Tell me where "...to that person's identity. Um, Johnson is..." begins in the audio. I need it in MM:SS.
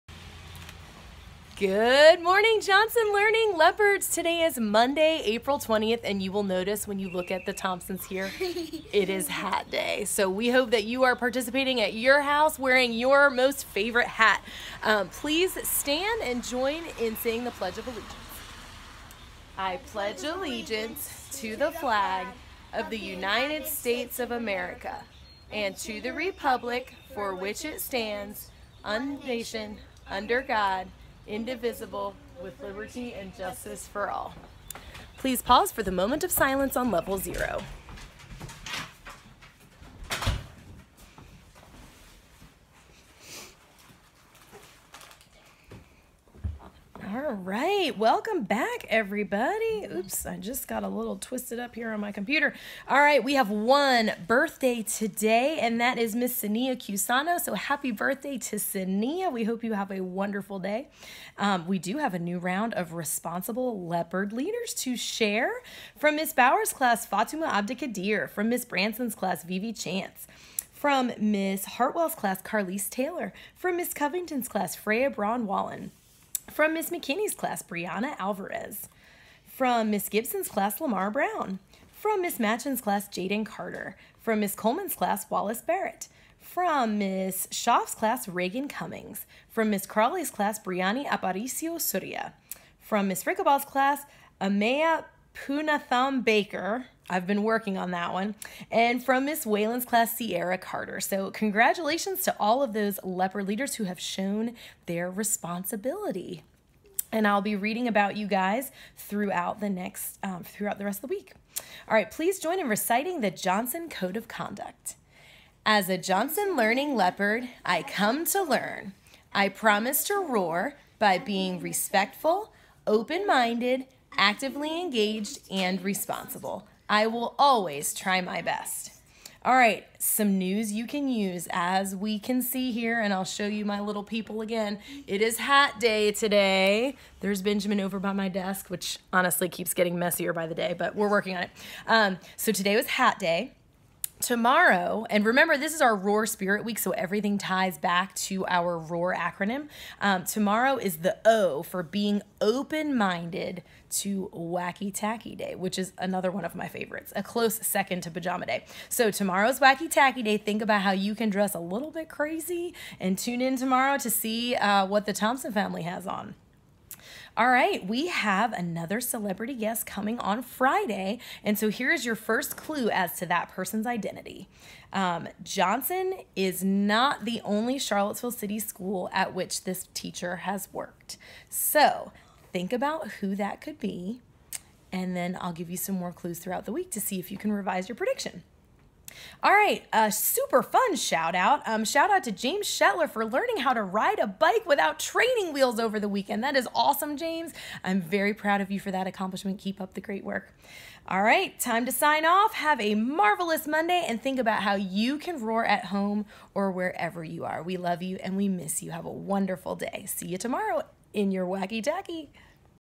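02:53.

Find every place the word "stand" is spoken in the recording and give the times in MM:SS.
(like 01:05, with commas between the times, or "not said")
00:15, 00:27.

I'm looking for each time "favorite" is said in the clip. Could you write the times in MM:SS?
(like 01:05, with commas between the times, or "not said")
00:13, 02:36.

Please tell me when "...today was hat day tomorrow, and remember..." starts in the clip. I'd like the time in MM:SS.
02:22.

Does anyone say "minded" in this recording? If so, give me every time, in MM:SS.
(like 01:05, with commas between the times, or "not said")
02:03, 02:32.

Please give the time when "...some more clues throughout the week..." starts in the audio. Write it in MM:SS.
03:05.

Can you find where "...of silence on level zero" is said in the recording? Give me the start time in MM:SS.
00:36.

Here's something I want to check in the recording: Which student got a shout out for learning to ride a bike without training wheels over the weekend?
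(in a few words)
James Shetler.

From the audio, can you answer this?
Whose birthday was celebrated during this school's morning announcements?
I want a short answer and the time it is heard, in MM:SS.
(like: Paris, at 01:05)
Sania Cusano, at 00:56.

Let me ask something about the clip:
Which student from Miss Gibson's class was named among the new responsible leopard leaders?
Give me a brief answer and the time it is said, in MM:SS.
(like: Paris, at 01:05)
Lamar Brown, at 01:20.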